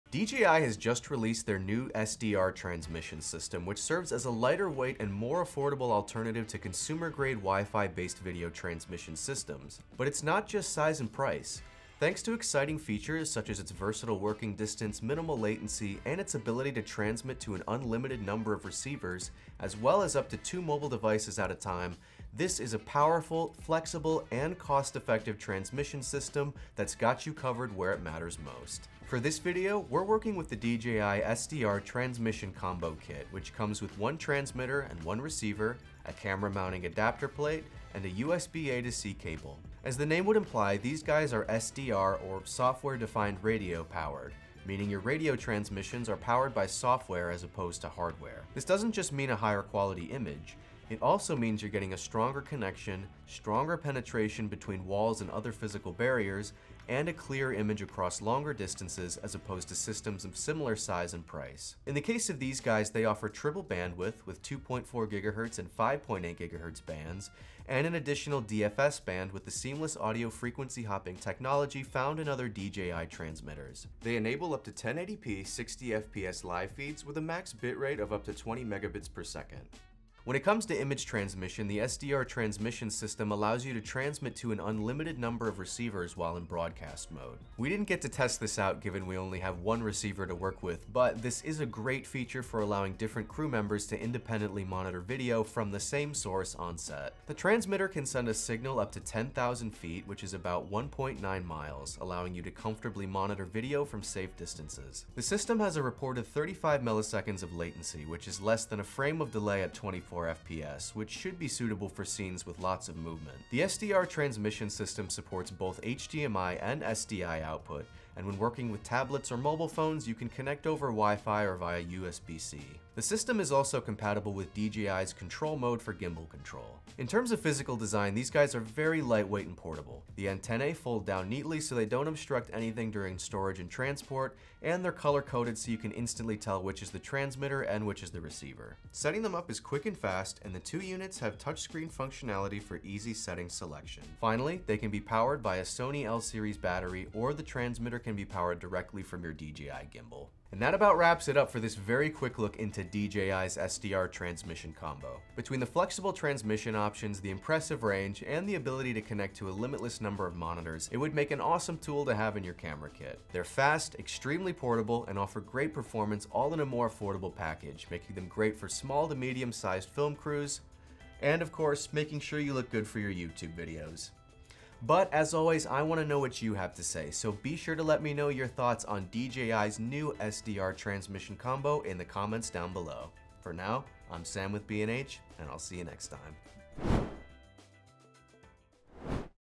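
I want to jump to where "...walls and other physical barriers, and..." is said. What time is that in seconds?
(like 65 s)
54 s.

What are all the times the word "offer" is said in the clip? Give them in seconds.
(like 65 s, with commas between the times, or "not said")
63 s, 165 s.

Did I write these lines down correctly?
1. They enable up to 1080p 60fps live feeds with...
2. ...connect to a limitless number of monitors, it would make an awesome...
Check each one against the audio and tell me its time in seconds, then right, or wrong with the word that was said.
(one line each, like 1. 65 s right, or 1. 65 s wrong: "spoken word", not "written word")
1. 74 s right
2. 159 s right.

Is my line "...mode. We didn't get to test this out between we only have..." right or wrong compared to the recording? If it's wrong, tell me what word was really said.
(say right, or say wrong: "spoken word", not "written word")
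wrong: "given", not "between".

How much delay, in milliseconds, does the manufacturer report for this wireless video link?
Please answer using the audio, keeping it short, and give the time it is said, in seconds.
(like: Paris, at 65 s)
35 milliseconds, at 106 s.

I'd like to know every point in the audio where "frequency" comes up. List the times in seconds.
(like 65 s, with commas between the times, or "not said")
70 s.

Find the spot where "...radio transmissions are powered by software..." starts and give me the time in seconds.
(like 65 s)
45 s.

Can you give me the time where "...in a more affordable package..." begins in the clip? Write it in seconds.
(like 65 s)
166 s.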